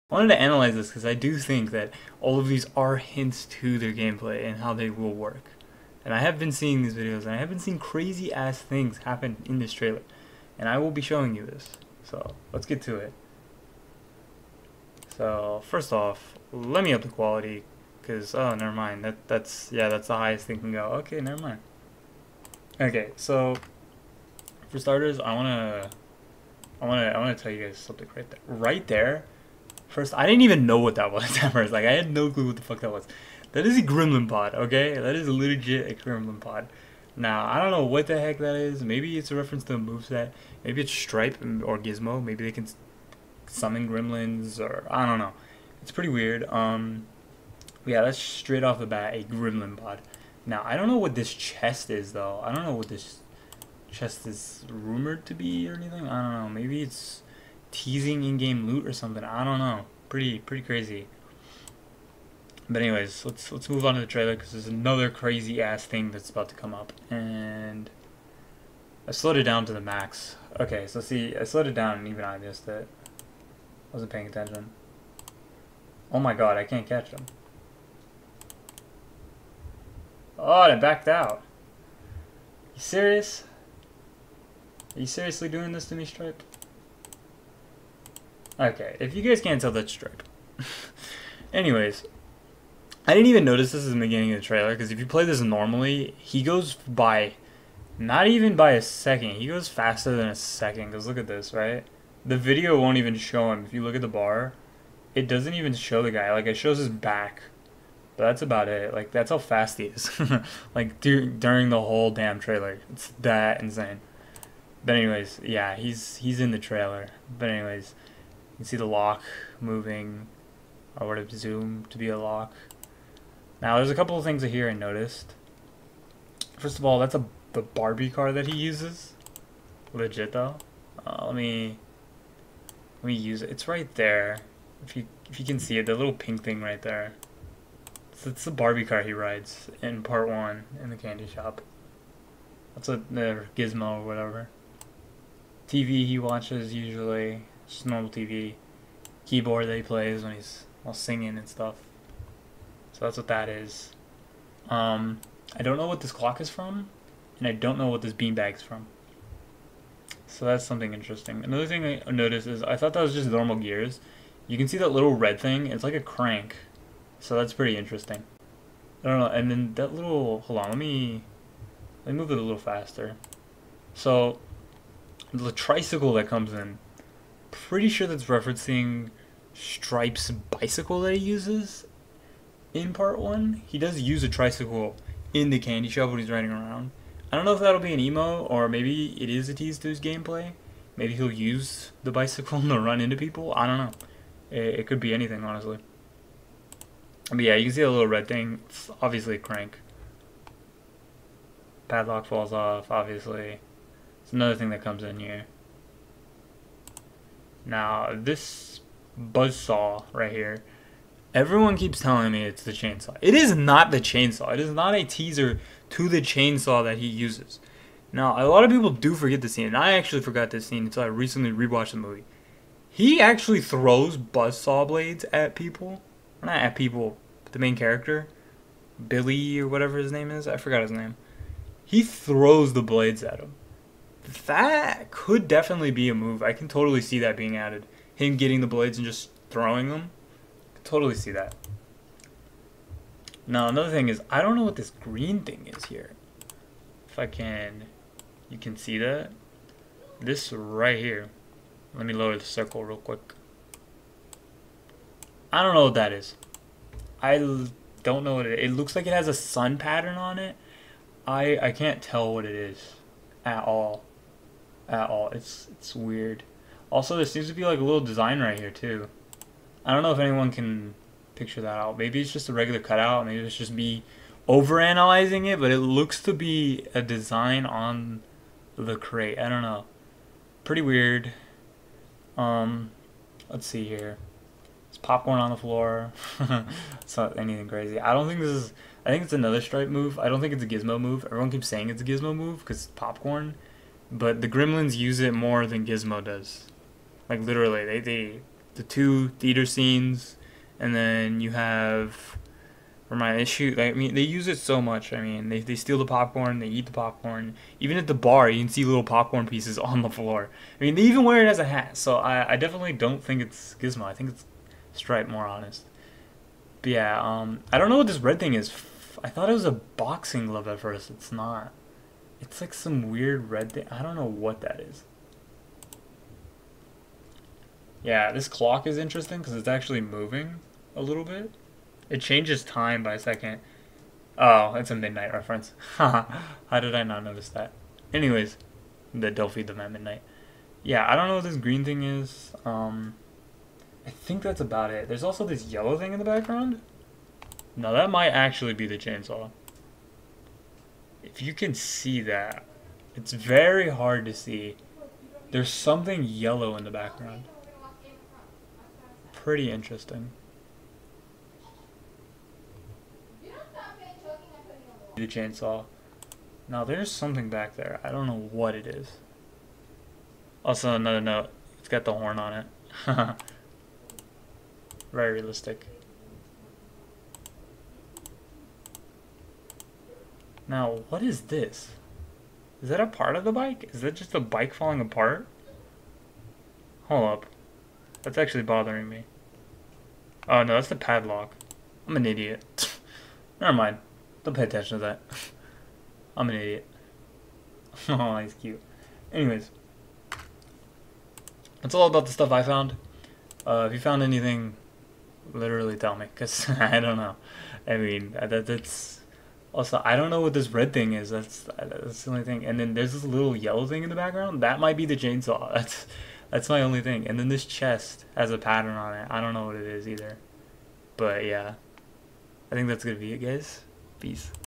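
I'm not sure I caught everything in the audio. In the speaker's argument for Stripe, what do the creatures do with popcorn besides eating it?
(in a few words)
Wear it as a hat.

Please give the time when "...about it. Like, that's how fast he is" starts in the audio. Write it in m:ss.
1:48.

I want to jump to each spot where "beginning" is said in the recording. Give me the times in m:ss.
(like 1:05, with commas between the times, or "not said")
1:34.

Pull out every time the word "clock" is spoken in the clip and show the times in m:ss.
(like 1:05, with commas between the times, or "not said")
2:36, 5:28.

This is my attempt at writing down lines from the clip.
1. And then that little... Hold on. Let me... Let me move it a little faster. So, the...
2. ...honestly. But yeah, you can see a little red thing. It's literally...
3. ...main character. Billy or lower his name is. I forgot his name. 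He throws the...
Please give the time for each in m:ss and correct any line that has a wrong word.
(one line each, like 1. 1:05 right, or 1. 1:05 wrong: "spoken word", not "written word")
1. 2:49 right
2. 3:15 wrong: "obviously", not "literally"
3. 3:47 wrong: "whatever", not "lower".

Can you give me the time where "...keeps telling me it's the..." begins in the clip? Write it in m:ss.
3:31.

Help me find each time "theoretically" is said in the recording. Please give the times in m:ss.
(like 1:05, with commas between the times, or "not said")
not said.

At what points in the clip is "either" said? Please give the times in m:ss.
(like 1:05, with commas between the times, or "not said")
7:00.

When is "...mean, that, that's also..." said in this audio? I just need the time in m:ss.
6:47.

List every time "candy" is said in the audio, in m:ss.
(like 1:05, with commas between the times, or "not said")
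2:20, 3:05.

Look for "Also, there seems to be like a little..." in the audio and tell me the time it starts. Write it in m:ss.
4:26.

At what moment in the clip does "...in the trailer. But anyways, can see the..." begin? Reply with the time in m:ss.
1:56.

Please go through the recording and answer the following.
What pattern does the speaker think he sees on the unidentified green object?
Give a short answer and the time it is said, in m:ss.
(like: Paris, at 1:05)
Sun pattern, at 4:19.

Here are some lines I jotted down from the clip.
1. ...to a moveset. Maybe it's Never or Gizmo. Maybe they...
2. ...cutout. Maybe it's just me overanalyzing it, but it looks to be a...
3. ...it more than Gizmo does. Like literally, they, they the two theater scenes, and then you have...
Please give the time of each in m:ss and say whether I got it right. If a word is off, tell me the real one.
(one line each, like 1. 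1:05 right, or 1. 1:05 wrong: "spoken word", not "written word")
1. 0:39 wrong: "Stripe", not "Never"
2. 4:32 right
3. 4:55 right.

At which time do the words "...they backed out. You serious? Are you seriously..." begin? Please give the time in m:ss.
1:20.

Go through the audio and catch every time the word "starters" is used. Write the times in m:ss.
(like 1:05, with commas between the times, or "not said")
0:24.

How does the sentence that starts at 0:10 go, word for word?
And I will be showing you this.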